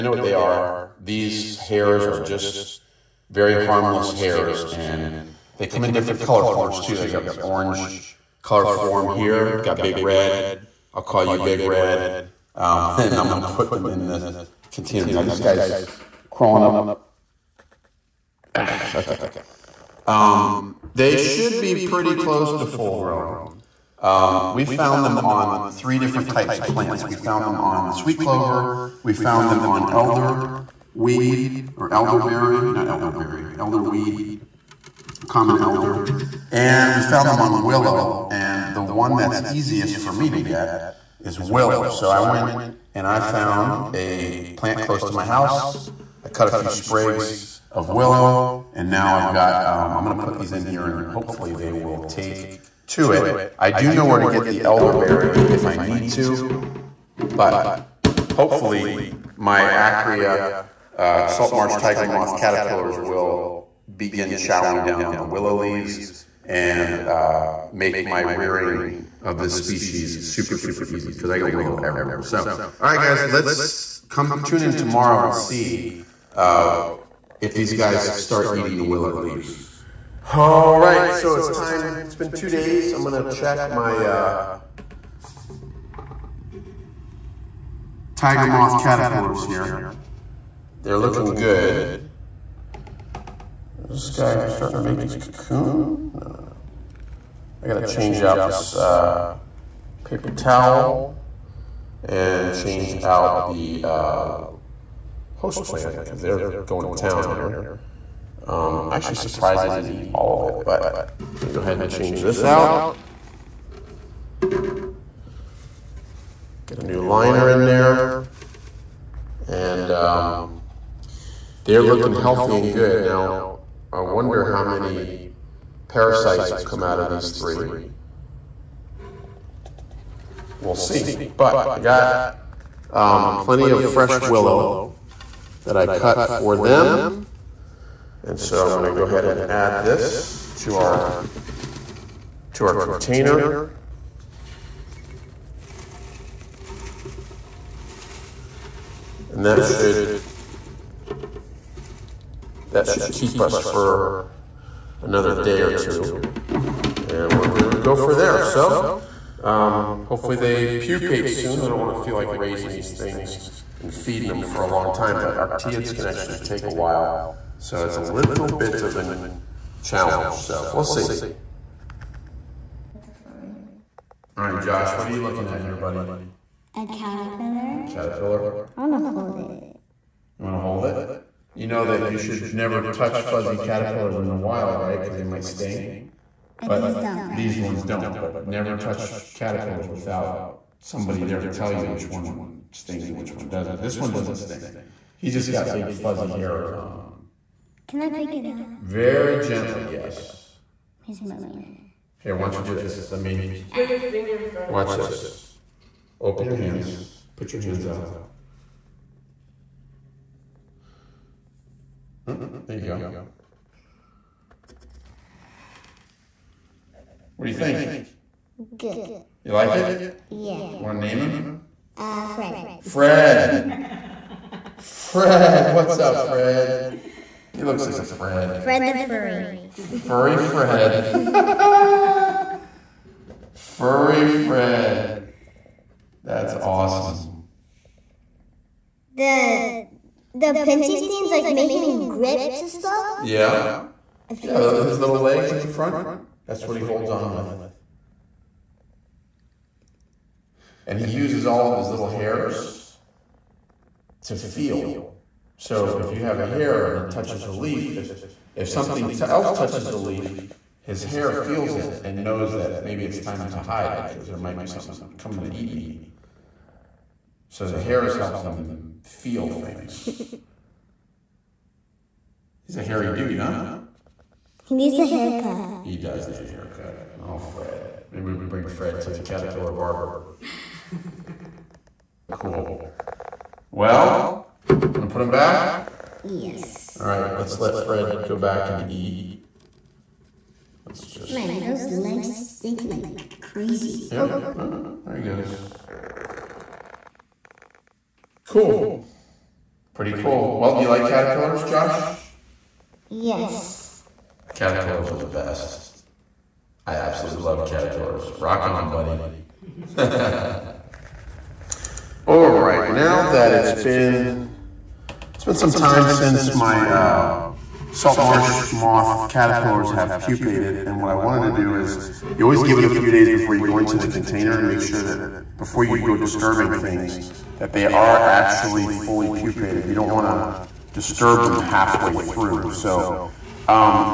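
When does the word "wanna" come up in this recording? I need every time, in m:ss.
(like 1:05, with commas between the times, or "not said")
2:41.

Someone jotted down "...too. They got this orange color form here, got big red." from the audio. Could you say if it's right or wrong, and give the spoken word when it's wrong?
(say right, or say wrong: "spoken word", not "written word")
right.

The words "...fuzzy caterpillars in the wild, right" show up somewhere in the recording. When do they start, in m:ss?
3:03.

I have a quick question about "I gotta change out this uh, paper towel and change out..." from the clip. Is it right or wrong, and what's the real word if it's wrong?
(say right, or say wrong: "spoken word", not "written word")
right.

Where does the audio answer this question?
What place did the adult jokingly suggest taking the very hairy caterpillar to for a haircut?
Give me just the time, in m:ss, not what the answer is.
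4:39.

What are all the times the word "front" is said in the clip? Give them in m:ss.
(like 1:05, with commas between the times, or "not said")
3:24, 4:05.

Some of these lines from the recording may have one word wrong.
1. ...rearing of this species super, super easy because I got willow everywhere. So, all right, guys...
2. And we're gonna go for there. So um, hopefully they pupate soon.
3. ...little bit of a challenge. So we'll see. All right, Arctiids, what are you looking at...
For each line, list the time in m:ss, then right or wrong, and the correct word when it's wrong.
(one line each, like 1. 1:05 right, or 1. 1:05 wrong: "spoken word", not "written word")
1. 1:08 right
2. 2:36 right
3. 2:48 wrong: "Josh", not "Arctiids".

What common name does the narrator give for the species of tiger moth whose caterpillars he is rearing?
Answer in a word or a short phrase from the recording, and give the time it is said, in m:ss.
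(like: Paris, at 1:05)
Salt marsh tiger moth, at 1:01.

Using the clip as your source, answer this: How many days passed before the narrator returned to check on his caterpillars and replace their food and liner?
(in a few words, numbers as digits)
2.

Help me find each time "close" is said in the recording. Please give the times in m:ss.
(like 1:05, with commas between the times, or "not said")
0:22, 0:44.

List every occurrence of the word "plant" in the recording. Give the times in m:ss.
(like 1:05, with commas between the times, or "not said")
0:26, 0:44, 1:45.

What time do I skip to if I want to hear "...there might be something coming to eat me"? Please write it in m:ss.
4:24.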